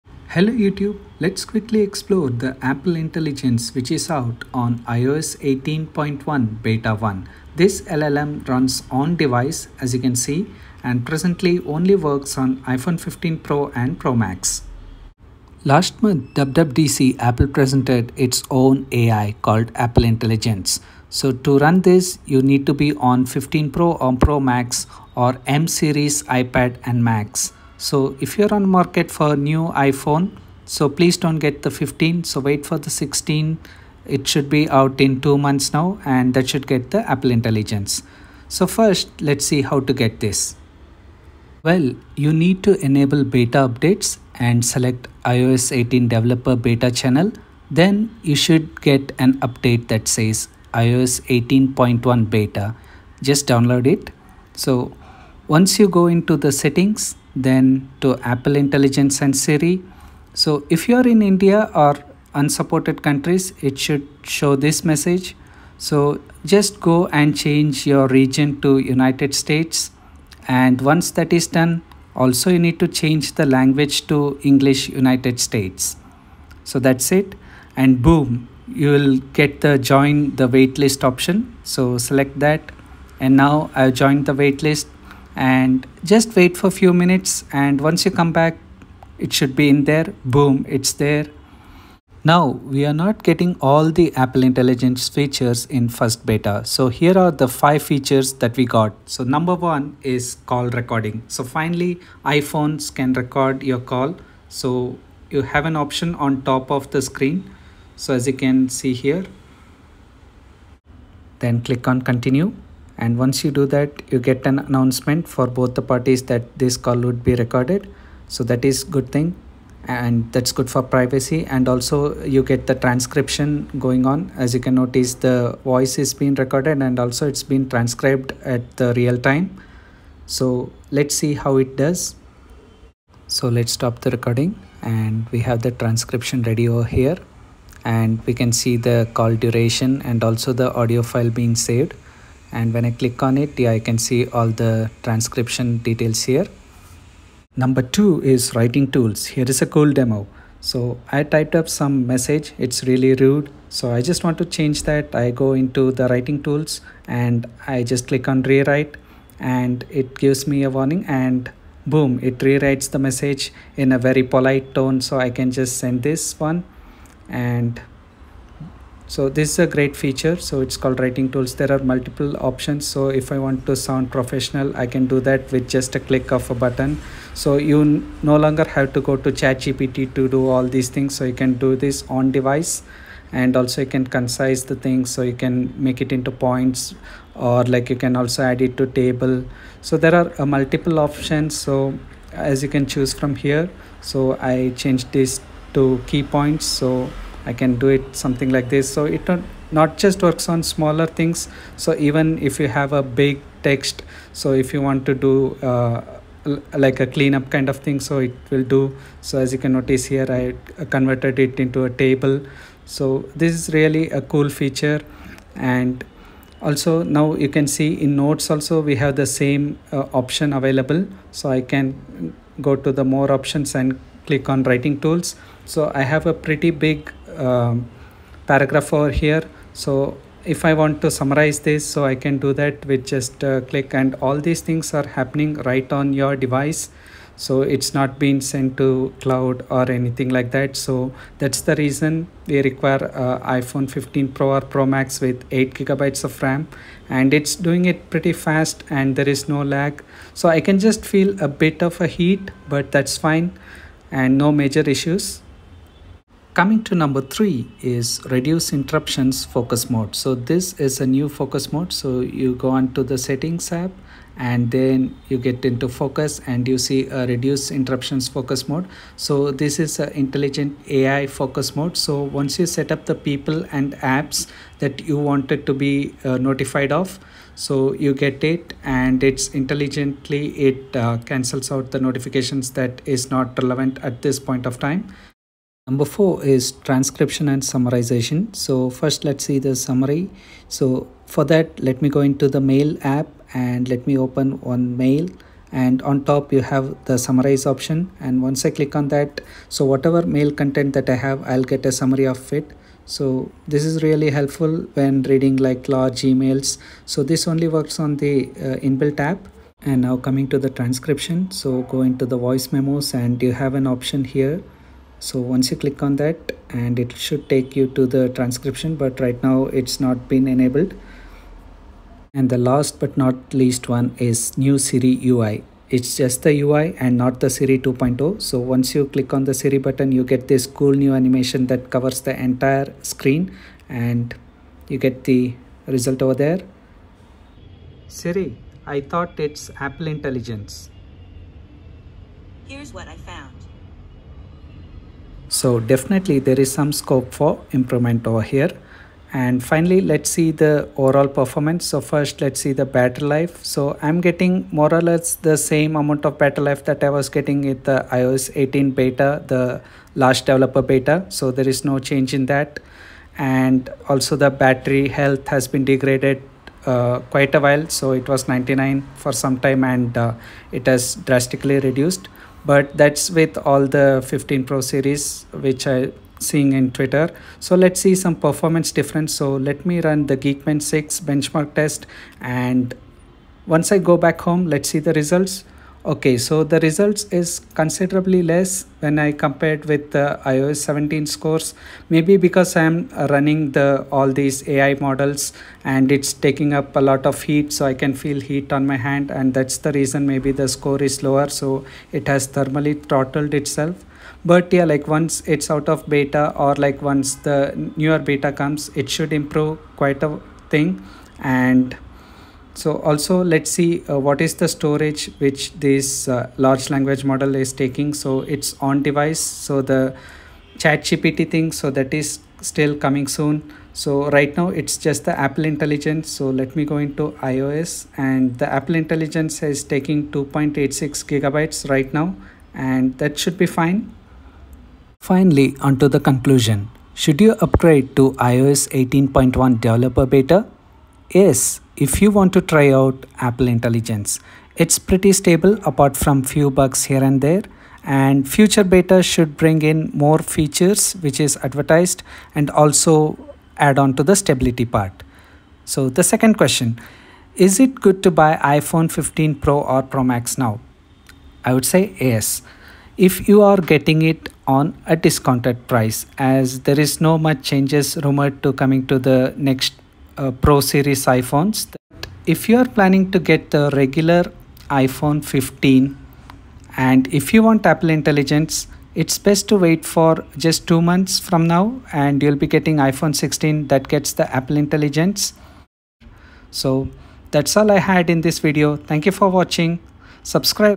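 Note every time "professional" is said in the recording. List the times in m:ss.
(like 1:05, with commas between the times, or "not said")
2:54.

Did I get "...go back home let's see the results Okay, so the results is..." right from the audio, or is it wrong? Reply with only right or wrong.
right.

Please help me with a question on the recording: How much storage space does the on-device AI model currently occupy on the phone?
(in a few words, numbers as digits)
2.86 GB.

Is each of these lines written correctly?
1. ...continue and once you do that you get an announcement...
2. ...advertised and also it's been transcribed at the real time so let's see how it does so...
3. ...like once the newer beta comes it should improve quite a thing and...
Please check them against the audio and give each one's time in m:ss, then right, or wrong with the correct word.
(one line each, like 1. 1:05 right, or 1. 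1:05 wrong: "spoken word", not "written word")
1. 1:52 right
2. 2:06 wrong: "recorded", not "advertised"
3. 6:46 right.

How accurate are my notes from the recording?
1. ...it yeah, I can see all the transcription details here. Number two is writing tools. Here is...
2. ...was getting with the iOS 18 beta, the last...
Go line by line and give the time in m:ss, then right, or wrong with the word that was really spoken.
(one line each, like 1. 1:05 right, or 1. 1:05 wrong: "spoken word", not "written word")
1. 2:23 right
2. 5:57 right.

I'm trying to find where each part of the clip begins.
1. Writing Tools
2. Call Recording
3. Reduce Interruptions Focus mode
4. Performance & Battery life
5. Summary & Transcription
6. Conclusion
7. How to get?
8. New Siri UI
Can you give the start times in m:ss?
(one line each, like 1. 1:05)
1. 2:25
2. 1:40
3. 4:16
4. 5:50
5. 4:47
6. 7:14
7. 0:38
8. 5:23.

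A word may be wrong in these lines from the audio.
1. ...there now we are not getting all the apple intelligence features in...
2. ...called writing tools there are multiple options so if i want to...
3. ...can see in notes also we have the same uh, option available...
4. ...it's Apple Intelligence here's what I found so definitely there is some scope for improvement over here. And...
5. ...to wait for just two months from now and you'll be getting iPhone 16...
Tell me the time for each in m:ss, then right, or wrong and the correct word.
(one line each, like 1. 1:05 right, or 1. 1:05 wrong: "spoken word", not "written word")
1. 1:30 right
2. 2:50 right
3. 3:37 right
4. 5:39 right
5. 7:59 right.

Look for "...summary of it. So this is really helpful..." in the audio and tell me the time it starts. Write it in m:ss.
5:01.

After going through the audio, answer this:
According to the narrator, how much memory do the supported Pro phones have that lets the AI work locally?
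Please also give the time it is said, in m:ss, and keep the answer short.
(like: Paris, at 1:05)
8 gigabytes, at 4:05.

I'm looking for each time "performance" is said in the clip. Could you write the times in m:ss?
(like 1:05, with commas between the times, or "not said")
5:51, 6:18.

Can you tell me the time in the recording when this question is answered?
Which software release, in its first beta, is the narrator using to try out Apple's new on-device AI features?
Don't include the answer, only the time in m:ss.
0:04.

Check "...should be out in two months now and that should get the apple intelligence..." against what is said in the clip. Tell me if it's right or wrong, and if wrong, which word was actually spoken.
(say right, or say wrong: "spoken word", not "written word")
right.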